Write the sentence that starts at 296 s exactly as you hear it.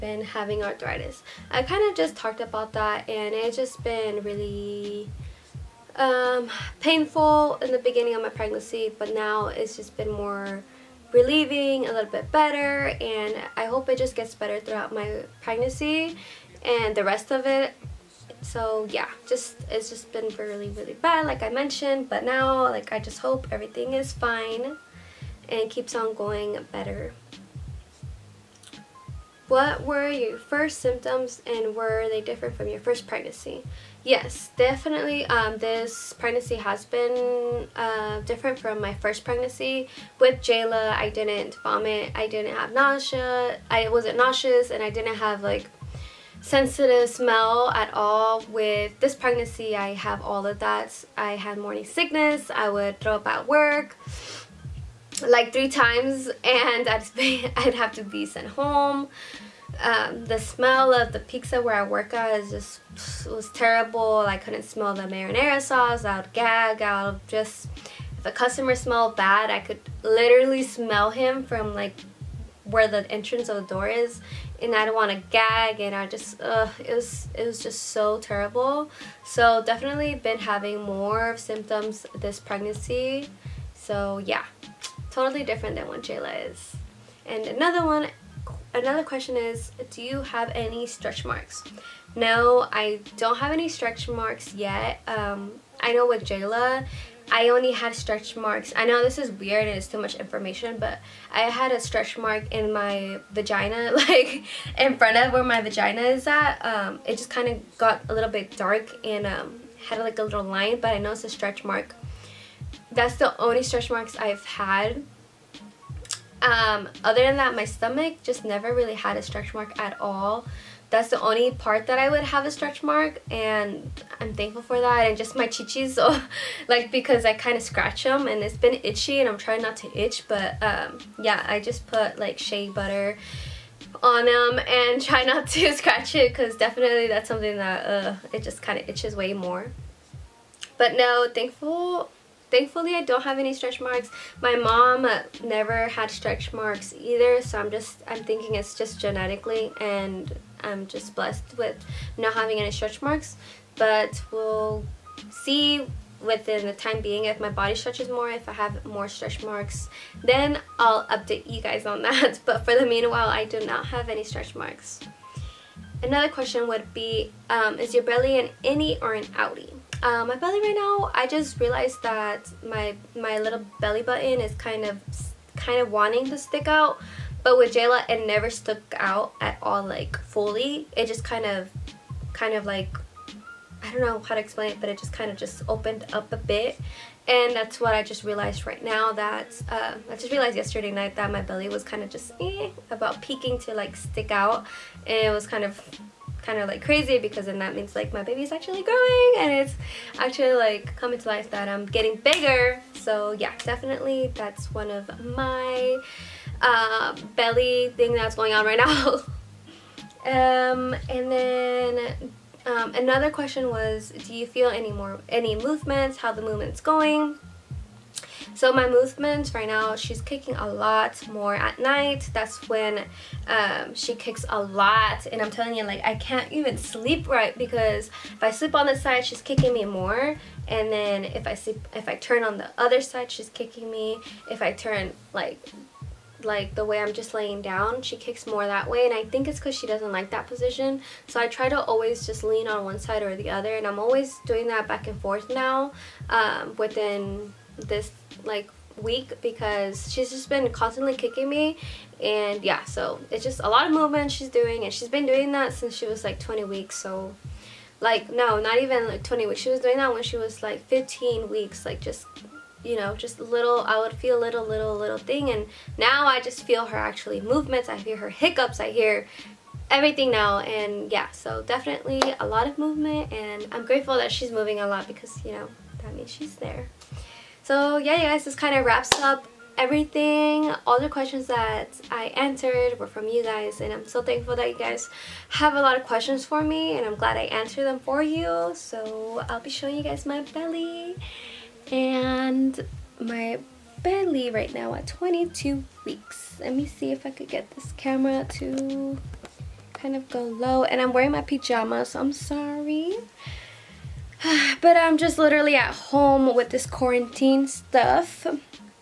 Let me see if I could get this camera to kind of go low.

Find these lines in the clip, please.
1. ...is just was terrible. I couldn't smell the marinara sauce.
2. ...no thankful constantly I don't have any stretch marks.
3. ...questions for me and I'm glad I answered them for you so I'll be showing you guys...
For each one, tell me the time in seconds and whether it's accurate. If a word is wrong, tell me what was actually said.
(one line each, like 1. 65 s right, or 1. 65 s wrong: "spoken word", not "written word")
1. 62 s right
2. 140 s wrong: "thankfully", not "constantly"
3. 286 s right.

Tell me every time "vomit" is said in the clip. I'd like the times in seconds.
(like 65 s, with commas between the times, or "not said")
41 s.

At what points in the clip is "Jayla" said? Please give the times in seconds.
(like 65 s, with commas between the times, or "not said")
40 s, 86 s, 96 s, 177 s.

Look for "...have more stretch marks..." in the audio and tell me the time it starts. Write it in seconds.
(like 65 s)
158 s.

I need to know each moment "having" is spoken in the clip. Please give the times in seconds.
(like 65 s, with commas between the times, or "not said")
0 s, 80 s, 152 s.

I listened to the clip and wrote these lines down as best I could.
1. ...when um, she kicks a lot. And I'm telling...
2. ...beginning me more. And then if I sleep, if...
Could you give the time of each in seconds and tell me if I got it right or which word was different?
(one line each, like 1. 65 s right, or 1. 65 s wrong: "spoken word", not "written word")
1. 222 s right
2. 229 s wrong: "kicking", not "beginning".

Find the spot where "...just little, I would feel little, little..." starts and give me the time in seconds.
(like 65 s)
263 s.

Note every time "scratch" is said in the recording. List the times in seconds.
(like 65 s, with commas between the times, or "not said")
127 s, 135 s.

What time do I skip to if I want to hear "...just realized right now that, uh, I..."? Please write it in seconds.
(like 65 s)
188 s.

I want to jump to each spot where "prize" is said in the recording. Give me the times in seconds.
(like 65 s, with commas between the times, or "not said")
not said.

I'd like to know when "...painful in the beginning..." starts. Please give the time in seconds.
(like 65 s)
6 s.